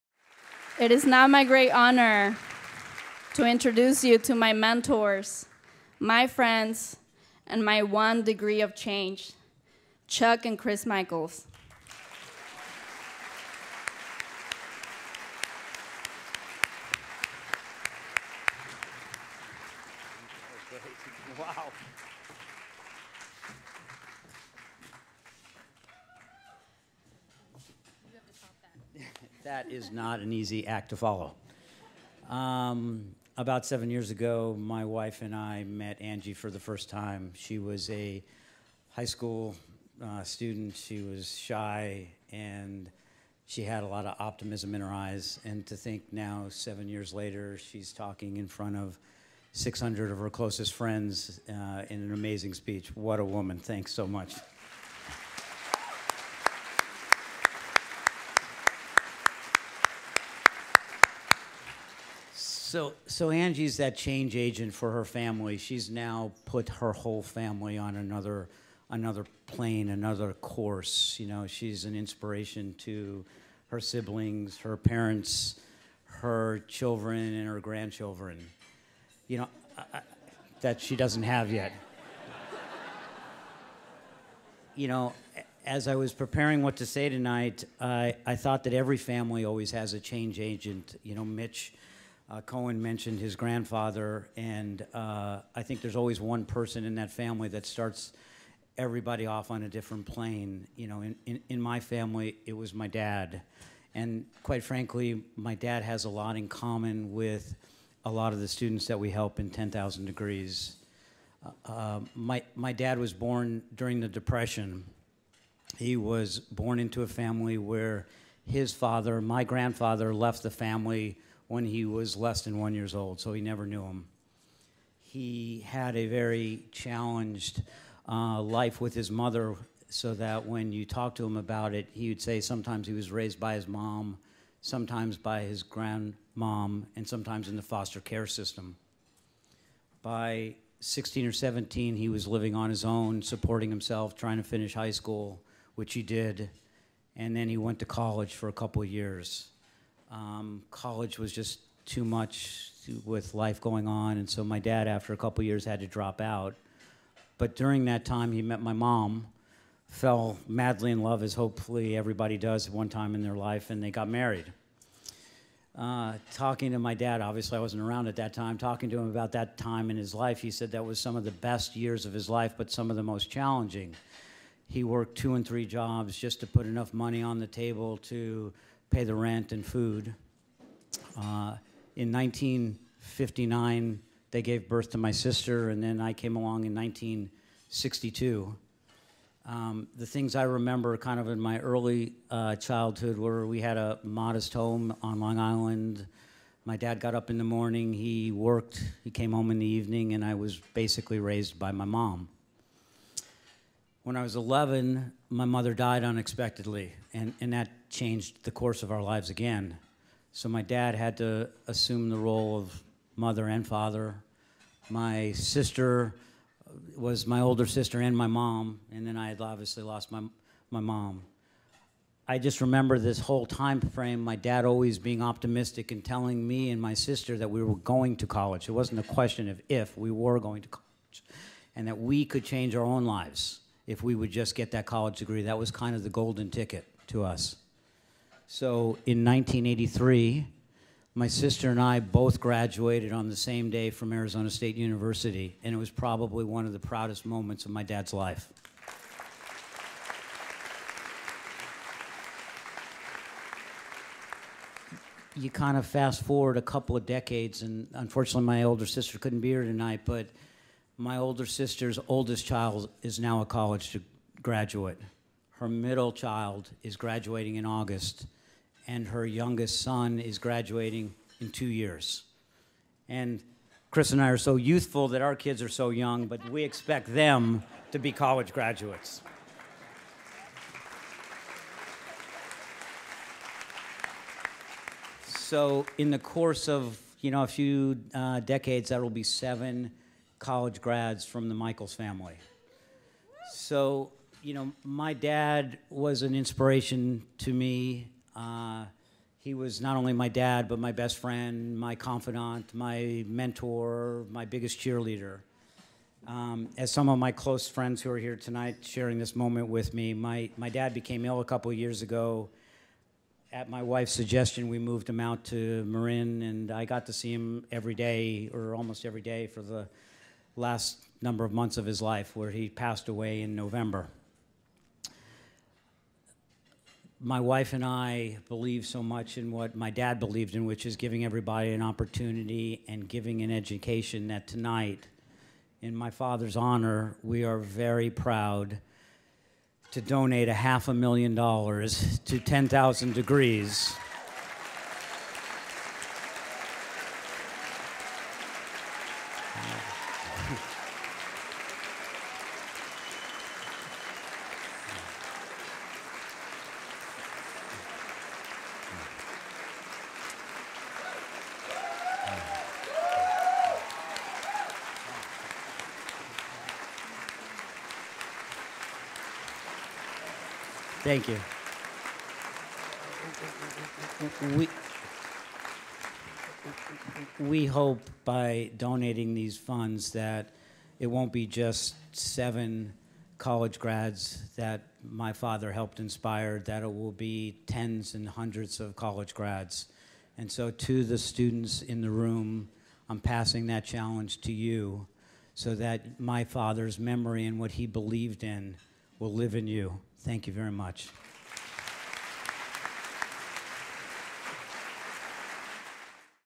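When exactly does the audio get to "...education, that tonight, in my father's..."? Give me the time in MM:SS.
05:33.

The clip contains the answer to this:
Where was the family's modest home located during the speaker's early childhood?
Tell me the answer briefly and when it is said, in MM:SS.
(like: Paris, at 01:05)
Long Island, at 03:15.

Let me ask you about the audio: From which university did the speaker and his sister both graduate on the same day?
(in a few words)
Arizona State University.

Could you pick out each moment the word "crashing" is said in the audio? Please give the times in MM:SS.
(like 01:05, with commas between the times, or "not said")
not said.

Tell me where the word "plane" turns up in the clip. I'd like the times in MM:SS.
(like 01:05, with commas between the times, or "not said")
01:09, 01:40.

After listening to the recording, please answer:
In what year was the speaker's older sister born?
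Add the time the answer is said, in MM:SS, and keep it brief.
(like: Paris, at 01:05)
1959, at 03:02.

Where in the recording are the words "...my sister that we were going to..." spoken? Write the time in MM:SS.
03:46.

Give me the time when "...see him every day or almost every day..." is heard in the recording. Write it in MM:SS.
05:17.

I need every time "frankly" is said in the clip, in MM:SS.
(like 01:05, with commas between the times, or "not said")
01:44.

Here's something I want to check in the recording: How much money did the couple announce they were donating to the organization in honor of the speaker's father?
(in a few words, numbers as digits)
half a million dollars.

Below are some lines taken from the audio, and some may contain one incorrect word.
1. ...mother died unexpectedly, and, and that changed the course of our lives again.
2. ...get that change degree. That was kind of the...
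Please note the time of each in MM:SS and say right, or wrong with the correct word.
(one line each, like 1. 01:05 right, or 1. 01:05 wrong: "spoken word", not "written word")
1. 03:25 right
2. 03:54 wrong: "college", not "change".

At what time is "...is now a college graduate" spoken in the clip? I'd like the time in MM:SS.
04:23.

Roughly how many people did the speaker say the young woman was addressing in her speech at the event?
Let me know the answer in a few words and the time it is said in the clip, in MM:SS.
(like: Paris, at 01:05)
600, at 00:49.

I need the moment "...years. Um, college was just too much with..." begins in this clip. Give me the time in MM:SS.
02:28.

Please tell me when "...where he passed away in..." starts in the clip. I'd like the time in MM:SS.
05:22.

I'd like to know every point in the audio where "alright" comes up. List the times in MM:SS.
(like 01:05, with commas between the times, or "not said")
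not said.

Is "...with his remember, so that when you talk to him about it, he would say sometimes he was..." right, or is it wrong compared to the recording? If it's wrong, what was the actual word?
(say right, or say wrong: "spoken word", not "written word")
wrong: "mother", not "remember".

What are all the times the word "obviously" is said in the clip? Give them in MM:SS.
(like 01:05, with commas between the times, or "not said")
02:47, 03:39.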